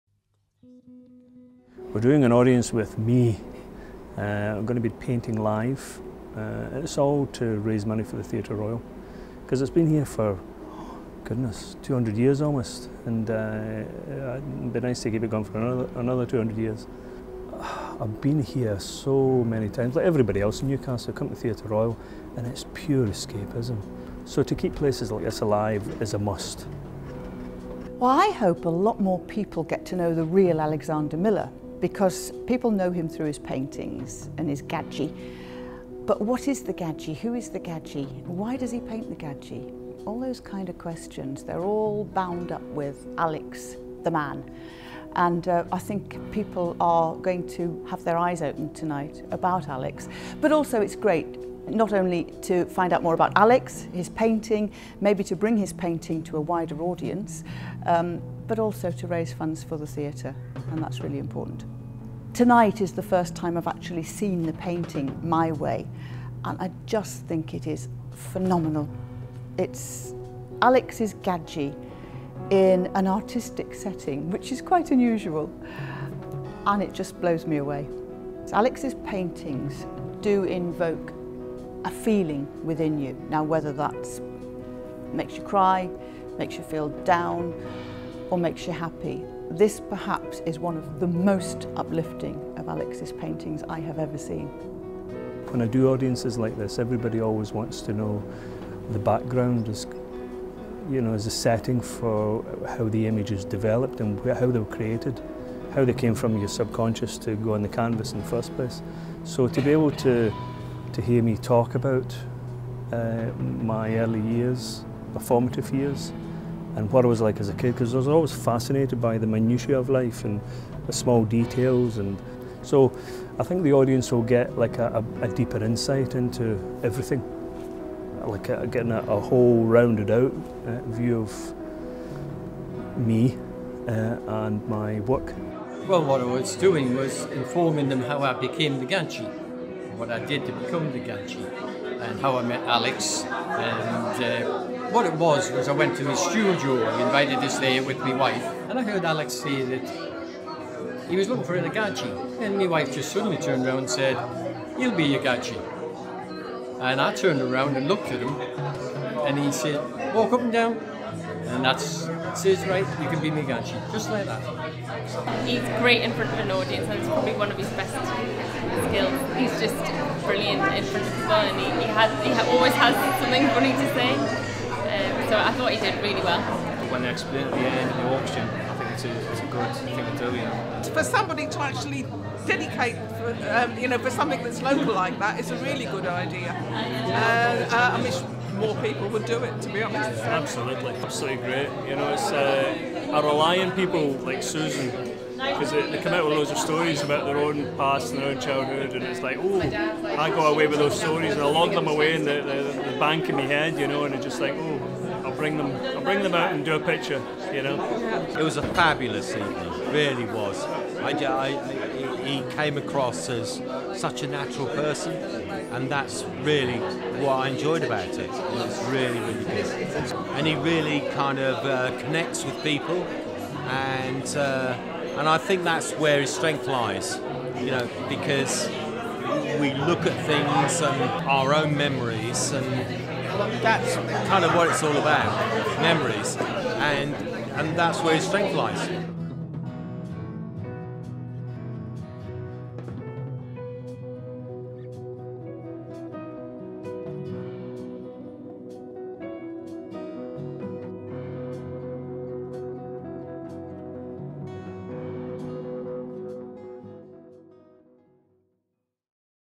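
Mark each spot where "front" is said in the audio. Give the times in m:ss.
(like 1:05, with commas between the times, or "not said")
2:46, 2:50.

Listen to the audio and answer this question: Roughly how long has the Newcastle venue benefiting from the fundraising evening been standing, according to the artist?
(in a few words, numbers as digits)
almost 200 years.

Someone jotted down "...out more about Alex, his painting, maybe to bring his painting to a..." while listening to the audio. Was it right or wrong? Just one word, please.
right.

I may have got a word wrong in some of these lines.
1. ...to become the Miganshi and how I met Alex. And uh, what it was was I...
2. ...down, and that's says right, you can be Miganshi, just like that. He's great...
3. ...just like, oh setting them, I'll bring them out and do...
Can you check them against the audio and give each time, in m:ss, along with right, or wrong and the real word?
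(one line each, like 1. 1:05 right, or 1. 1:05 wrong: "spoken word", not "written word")
1. 2:20 wrong: "Gadgie", not "Miganshi"
2. 2:40 right
3. 3:24 wrong: "bring", not "setting".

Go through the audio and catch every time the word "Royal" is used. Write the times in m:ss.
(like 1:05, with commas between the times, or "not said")
0:08, 0:21.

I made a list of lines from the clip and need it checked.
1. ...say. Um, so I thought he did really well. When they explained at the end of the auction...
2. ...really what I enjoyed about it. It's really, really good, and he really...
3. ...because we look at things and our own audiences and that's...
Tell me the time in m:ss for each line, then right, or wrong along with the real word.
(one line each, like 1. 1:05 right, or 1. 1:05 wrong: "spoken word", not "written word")
1. 2:53 right
2. 3:36 right
3. 3:48 wrong: "memories", not "audiences".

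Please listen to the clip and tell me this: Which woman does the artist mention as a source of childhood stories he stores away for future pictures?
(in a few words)
Susan.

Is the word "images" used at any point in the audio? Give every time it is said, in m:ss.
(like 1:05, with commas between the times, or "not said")
1:43.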